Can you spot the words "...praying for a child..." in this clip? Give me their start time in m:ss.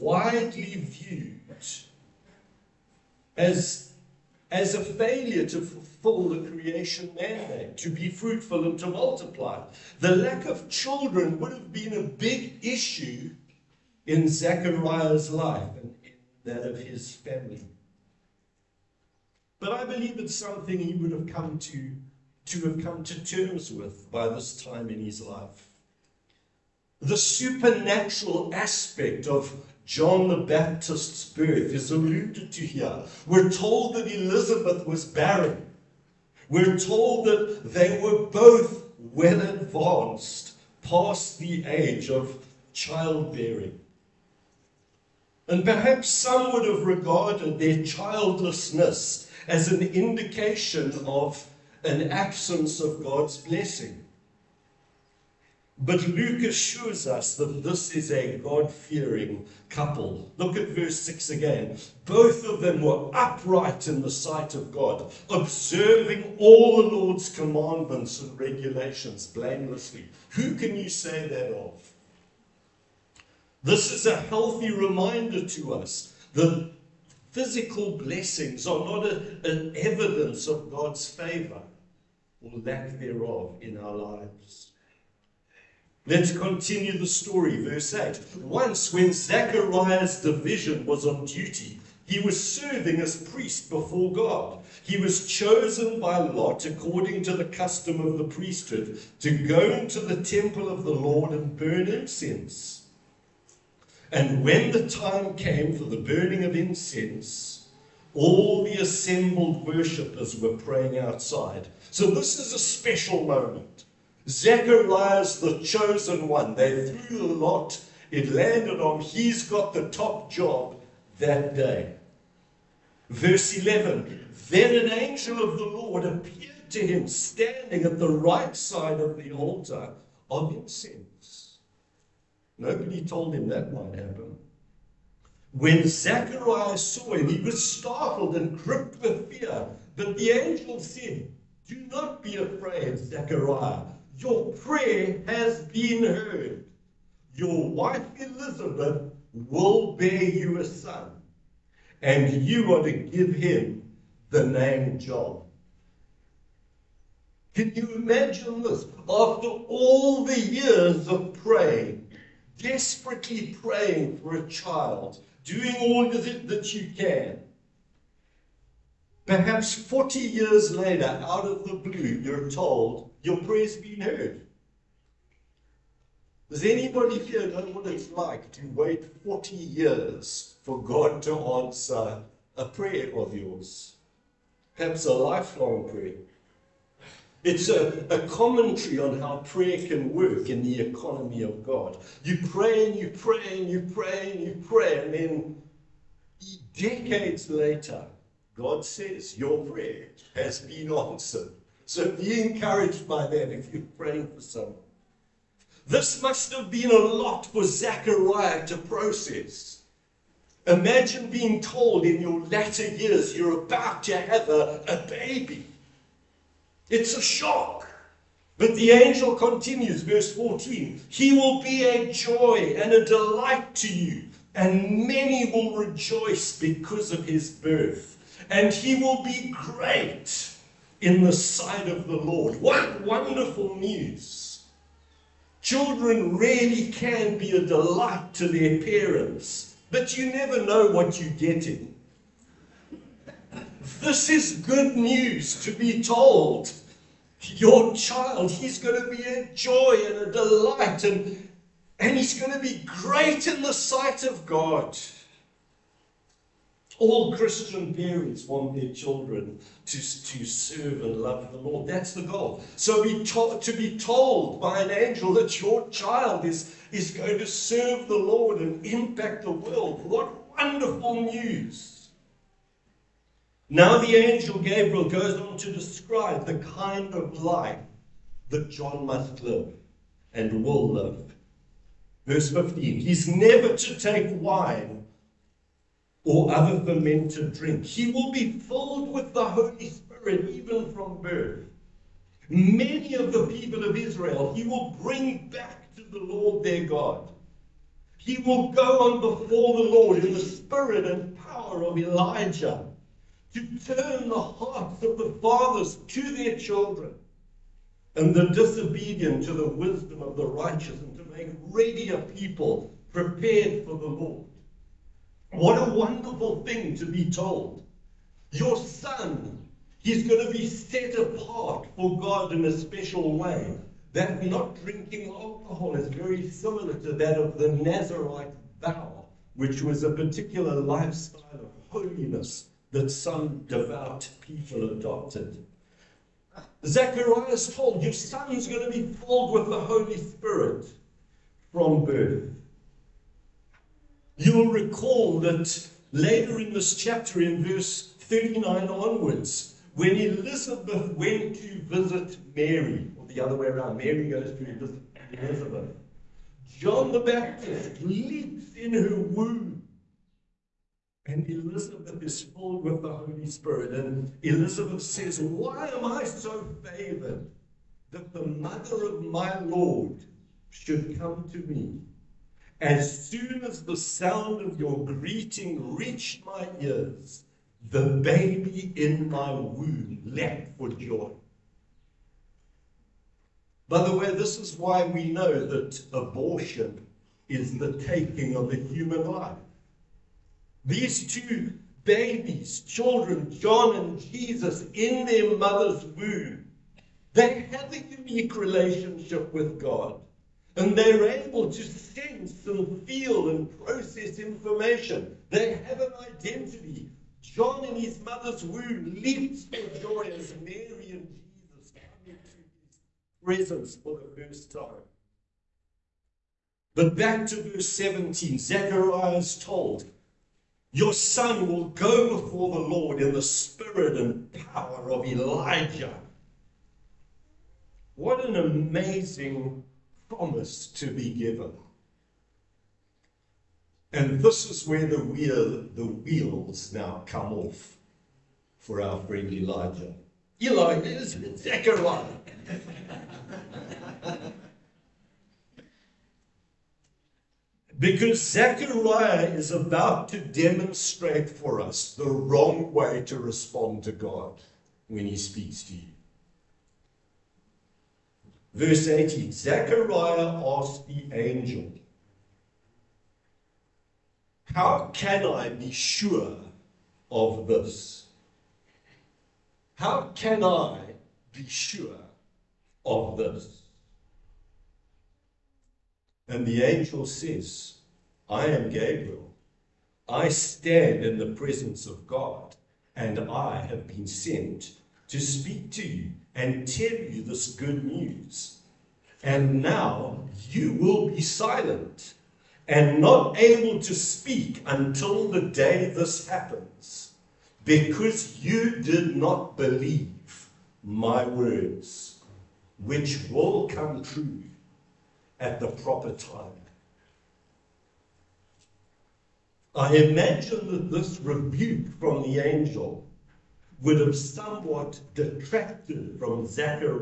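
2:43.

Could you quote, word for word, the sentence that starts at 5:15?
What a wonderful thing to be told.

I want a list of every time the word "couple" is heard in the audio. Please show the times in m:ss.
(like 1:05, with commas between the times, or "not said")
0:59.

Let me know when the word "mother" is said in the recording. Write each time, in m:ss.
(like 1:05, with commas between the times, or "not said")
6:08, 6:35, 6:48.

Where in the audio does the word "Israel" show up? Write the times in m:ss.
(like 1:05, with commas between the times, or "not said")
4:53.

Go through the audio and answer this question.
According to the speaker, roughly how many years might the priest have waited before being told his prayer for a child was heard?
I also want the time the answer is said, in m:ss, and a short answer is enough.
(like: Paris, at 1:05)
40, at 2:49.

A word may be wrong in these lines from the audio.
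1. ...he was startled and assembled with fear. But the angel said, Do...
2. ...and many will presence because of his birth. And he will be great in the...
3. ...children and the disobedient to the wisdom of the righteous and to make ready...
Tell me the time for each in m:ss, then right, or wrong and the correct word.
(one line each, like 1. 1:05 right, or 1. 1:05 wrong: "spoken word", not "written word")
1. 2:17 wrong: "gripped", not "assembled"
2. 3:44 wrong: "rejoice", not "presence"
3. 5:06 right.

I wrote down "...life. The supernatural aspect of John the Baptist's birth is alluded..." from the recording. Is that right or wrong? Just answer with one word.
right.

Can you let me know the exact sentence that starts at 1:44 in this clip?
And when the time came for the burning of incense, all the assembled worshippers were praying outside.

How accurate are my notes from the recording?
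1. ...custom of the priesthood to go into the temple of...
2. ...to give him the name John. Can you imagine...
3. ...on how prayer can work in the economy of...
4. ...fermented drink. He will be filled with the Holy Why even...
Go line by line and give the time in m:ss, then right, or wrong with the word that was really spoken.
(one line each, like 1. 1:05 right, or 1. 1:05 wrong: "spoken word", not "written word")
1. 1:37 right
2. 2:32 right
3. 3:08 right
4. 4:46 wrong: "Spirit", not "Why".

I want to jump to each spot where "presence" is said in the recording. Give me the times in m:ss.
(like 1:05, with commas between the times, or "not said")
6:53, 8:01.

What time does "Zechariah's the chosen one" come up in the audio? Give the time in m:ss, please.
1:54.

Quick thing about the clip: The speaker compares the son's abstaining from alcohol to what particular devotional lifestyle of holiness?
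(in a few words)
Nazarite vow.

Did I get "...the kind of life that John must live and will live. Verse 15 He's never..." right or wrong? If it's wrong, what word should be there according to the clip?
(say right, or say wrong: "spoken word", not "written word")
right.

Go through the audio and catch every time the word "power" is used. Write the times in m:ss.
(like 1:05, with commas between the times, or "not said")
5:01, 7:04.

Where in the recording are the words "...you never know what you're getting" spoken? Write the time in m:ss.
4:00.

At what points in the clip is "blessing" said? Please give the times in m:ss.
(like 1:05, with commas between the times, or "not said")
0:53, 1:17.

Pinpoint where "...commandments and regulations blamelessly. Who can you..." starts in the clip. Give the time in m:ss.
1:07.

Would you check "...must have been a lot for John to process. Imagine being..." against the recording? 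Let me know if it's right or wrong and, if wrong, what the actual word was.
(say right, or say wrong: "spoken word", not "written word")
wrong: "Zechariah", not "John".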